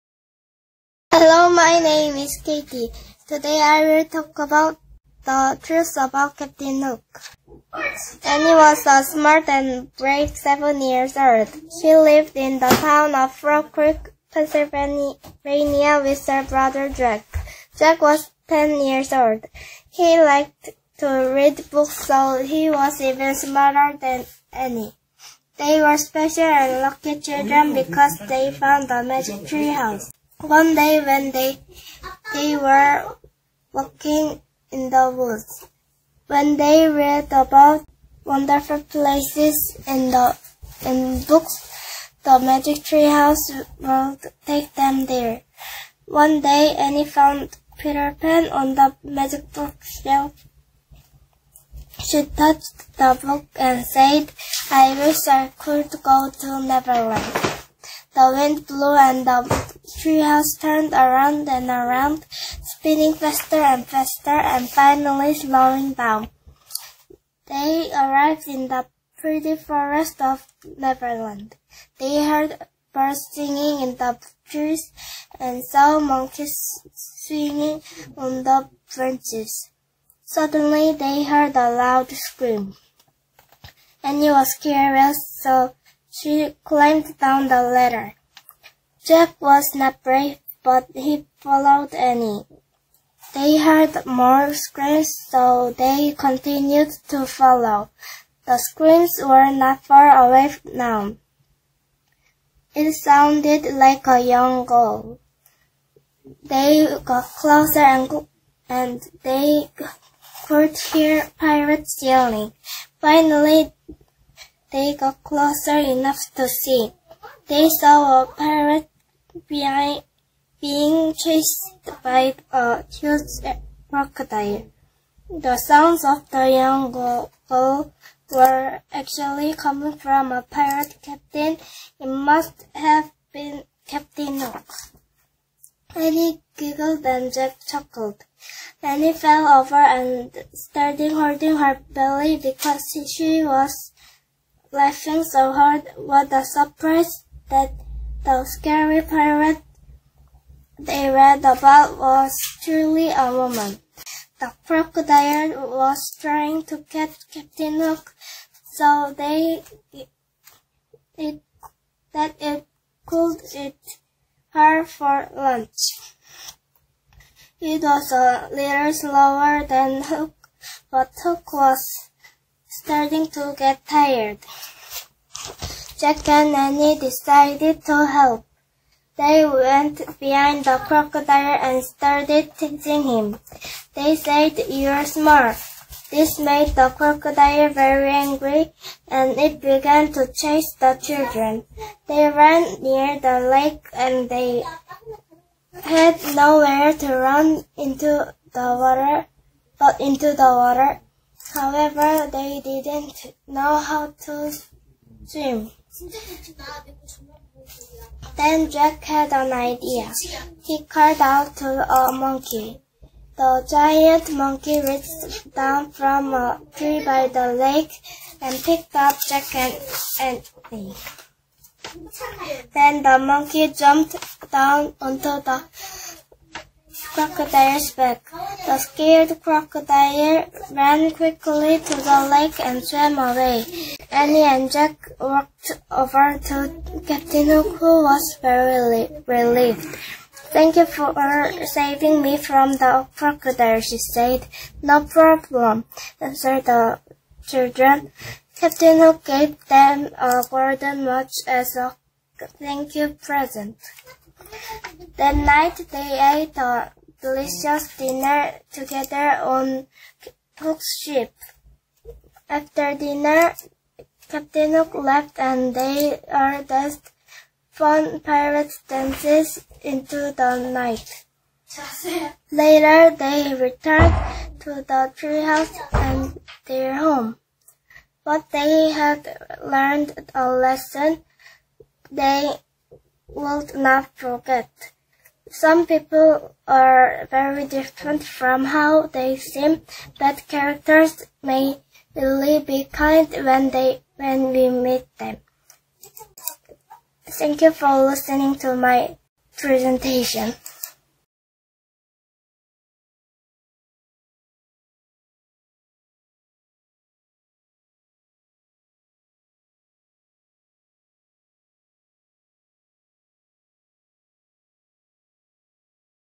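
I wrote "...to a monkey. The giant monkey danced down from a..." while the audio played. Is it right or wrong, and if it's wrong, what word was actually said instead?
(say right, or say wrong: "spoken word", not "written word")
wrong: "reached", not "danced".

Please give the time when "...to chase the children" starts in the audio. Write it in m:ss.
3:10.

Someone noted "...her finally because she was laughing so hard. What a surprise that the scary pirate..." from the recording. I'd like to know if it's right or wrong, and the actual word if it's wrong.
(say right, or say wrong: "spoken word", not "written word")
wrong: "belly", not "finally".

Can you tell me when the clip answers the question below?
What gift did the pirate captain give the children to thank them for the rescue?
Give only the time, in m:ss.
4:10.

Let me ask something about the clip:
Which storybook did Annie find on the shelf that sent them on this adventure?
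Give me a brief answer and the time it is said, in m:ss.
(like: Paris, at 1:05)
Peter Pan, at 0:47.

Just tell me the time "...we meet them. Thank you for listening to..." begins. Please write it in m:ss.
4:54.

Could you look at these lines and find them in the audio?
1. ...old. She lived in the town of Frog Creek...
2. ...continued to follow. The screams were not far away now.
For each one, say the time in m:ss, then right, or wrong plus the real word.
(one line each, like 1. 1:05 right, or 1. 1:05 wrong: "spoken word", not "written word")
1. 0:11 right
2. 1:36 right.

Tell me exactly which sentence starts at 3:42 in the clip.
Then the monkey jumped down onto the crocodile's back.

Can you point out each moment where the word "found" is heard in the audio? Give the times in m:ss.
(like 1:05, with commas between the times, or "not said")
0:28, 0:47.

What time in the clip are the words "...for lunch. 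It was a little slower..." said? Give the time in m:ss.
2:44.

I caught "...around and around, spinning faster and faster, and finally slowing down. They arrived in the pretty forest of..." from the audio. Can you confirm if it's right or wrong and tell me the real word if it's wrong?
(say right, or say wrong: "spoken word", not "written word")
right.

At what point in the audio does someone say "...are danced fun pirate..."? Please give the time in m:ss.
4:26.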